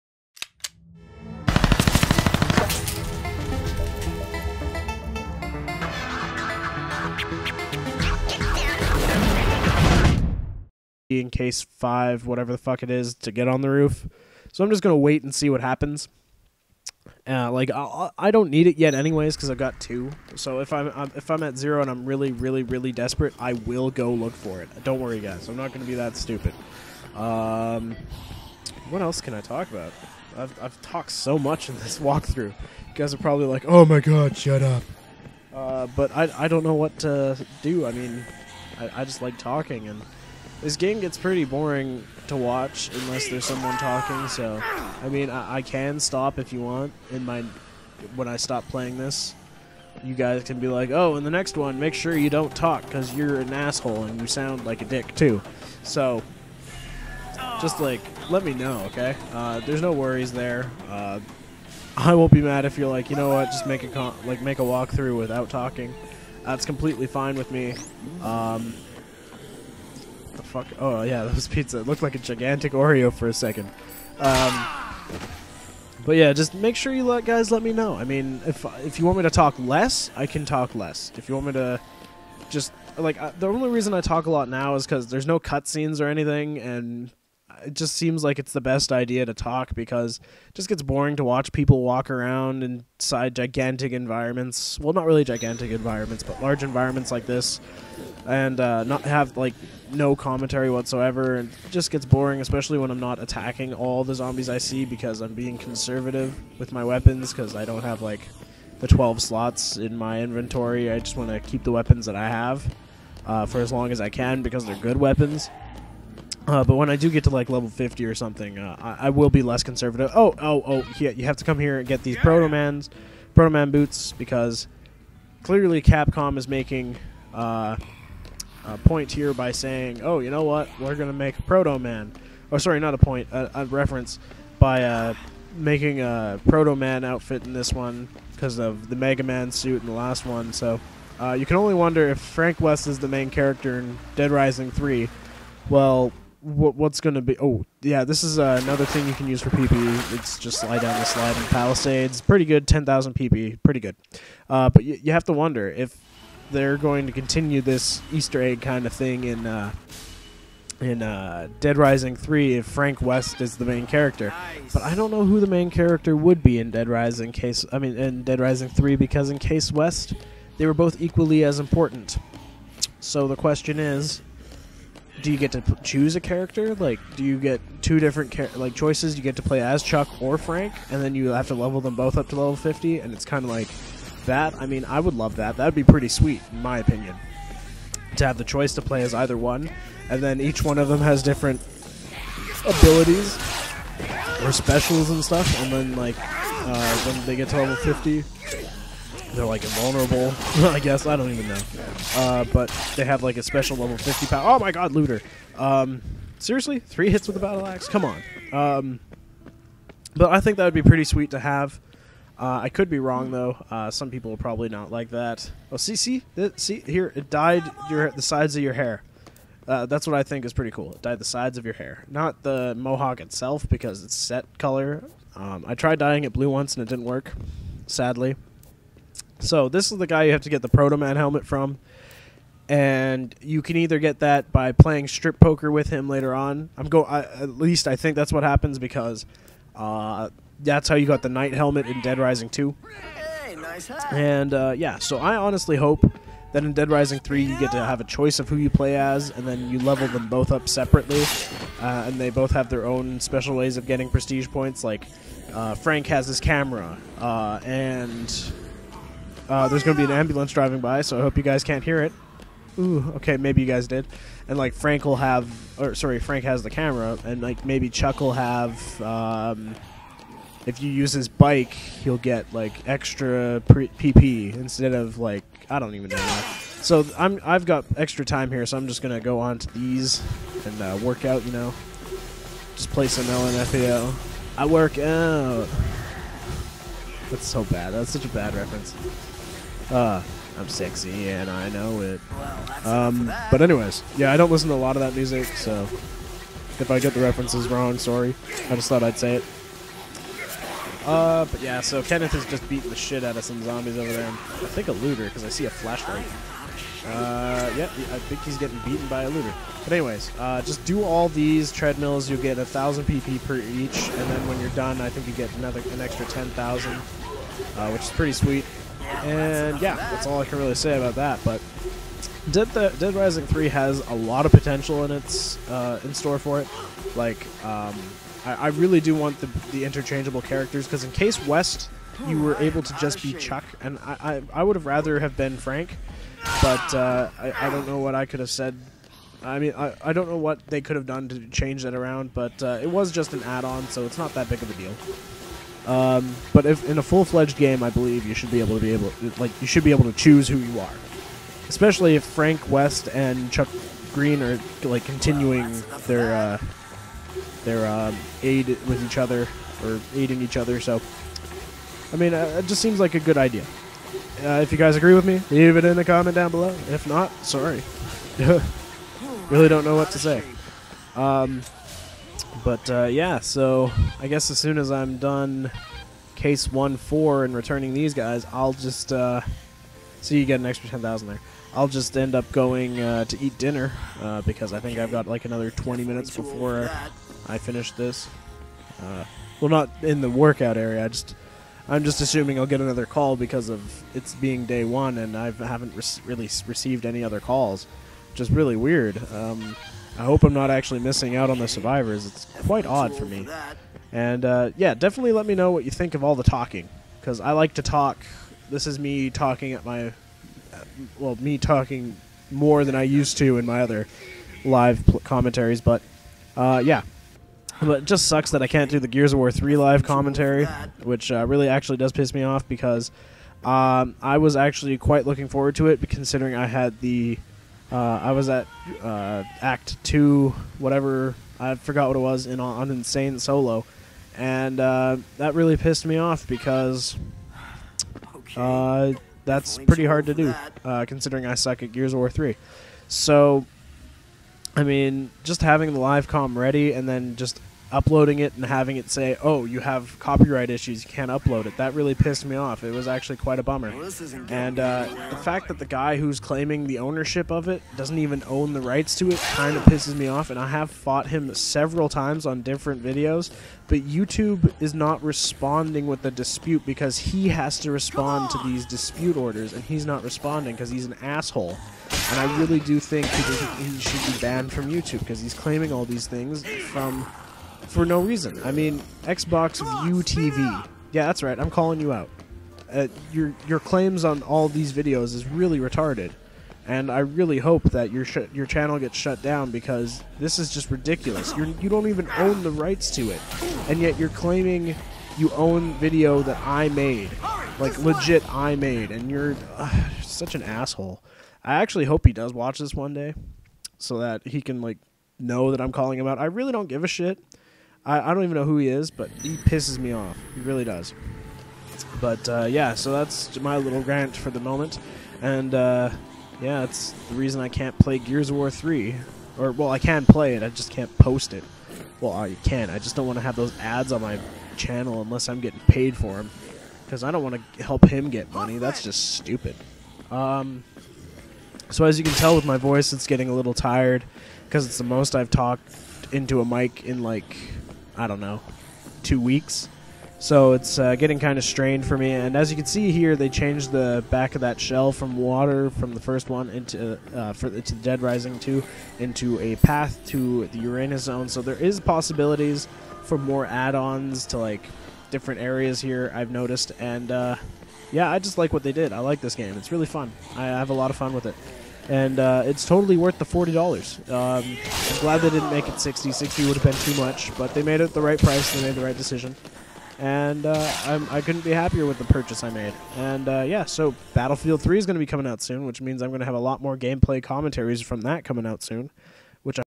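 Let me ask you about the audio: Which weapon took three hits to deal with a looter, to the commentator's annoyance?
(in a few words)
battle axe.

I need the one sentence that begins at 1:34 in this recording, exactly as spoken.
Well, not really gigantic environments, but large environments like this, and uh, not have like no commentary whatsoever.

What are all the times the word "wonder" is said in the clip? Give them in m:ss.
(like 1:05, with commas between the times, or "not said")
2:21, 2:35.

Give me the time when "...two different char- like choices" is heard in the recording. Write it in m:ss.
2:57.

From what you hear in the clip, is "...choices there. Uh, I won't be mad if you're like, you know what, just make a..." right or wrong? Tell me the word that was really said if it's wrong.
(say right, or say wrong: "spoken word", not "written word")
wrong: "worries", not "choices".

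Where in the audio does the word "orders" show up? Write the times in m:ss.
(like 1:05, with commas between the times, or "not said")
7:49.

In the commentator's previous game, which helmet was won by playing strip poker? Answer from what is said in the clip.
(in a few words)
Knight helmet.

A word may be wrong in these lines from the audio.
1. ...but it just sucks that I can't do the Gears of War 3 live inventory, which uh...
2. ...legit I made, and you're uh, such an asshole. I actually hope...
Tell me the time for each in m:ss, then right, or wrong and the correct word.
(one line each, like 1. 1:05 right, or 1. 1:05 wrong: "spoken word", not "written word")
1. 6:57 wrong: "commentary", not "inventory"
2. 8:17 right.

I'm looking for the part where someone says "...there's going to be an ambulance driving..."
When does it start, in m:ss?
4:19.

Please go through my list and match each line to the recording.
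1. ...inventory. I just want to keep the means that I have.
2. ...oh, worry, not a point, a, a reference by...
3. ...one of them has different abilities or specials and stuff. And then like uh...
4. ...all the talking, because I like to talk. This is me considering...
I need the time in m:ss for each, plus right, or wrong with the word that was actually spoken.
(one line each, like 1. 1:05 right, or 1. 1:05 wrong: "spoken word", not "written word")
1. 1:50 wrong: "weapons", not "means"
2. 2:12 wrong: "sorry", not "worry"
3. 3:10 right
4. 6:46 wrong: "talking", not "considering".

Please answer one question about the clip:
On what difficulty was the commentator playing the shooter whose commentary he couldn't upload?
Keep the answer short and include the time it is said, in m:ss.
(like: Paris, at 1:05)
Insane, at 7:12.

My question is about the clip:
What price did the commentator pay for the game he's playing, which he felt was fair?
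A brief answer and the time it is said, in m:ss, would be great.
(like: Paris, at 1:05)
$40, at 9:23.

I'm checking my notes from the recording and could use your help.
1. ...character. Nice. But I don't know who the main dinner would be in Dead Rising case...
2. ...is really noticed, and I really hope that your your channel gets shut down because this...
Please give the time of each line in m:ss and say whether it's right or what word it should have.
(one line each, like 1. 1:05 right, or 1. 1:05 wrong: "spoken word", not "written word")
1. 2:43 wrong: "character", not "dinner"
2. 8:05 wrong: "retarded", not "noticed".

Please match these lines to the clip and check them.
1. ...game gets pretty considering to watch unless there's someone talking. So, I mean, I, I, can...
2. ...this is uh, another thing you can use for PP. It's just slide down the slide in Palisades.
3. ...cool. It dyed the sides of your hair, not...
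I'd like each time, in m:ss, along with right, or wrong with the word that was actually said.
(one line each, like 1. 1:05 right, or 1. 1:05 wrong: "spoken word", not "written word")
1. 0:40 wrong: "boring", not "considering"
2. 2:28 right
3. 3:40 right.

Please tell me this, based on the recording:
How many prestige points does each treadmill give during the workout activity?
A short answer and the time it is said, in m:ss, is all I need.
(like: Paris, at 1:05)
1,000, at 5:12.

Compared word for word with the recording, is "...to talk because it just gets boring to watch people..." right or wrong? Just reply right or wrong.
right.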